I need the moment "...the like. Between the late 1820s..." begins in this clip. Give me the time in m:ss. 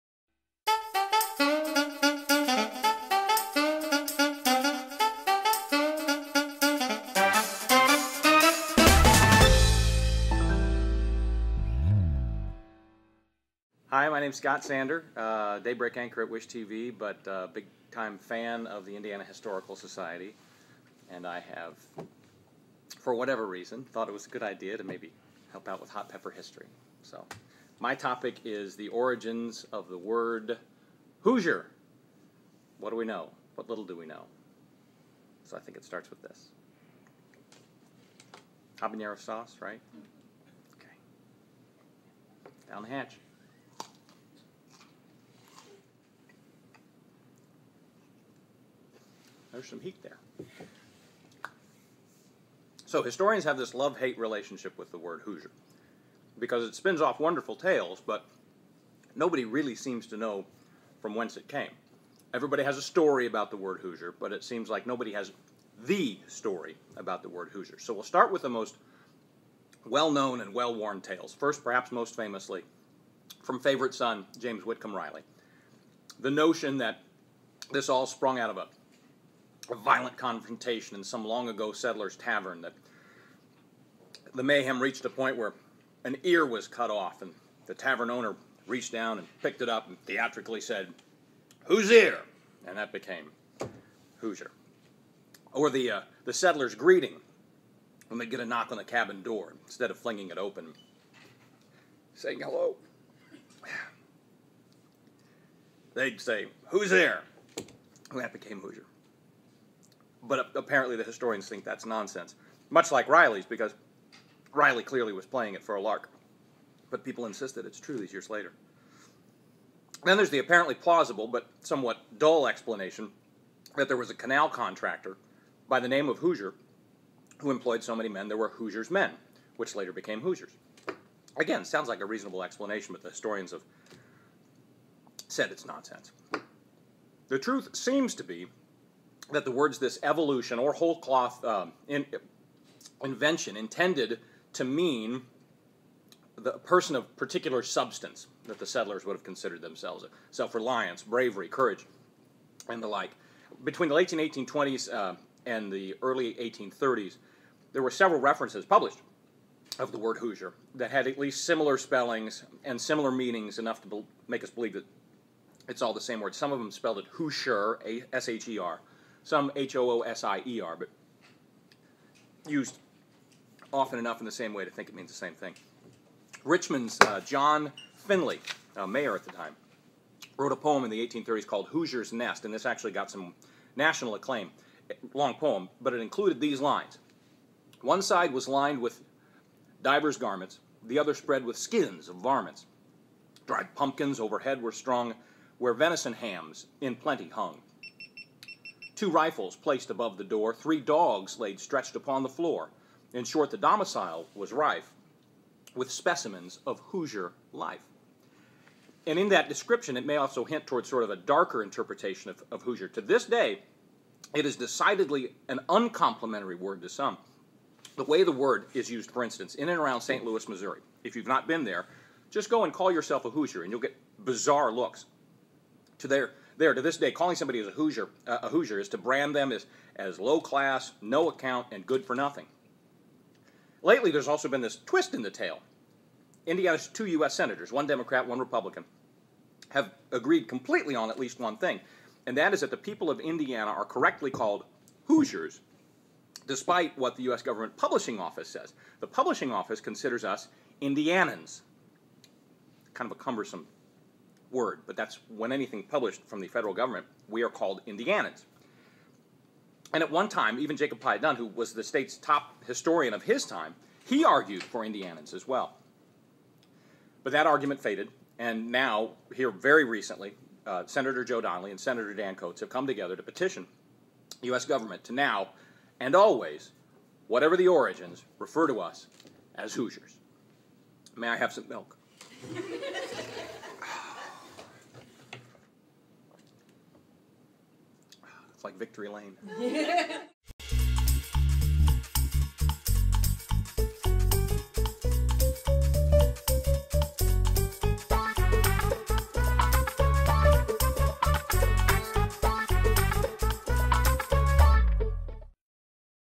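2:32.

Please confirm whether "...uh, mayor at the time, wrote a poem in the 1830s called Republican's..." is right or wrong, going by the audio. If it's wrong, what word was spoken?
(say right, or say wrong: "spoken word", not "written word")
wrong: "Hoosier", not "Republican".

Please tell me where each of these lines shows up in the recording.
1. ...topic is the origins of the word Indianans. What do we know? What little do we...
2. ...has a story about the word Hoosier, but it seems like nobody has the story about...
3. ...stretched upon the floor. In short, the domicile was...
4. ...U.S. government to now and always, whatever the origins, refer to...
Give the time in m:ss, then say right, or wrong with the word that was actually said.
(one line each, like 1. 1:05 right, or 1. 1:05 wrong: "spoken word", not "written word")
1. 0:27 wrong: "Hoosier", not "Indianans"
2. 1:02 right
3. 3:21 right
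4. 4:34 right.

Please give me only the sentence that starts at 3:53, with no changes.
Lately, there's also been this twist in the tale.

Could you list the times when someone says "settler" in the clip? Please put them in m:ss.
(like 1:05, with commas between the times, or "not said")
1:21, 1:36, 2:28.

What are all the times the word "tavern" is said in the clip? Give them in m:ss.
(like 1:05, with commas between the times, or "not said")
1:22, 1:27.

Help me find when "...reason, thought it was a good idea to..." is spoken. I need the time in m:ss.
0:23.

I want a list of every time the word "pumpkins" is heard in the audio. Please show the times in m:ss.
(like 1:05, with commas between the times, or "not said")
3:13.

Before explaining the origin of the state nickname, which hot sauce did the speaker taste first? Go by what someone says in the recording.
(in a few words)
Habanero sauce.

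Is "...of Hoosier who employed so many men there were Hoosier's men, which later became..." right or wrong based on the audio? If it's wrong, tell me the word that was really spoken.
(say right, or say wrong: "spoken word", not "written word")
right.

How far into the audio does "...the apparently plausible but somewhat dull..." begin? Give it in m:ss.
2:00.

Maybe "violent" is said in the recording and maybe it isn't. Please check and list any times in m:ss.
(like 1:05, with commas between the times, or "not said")
1:19.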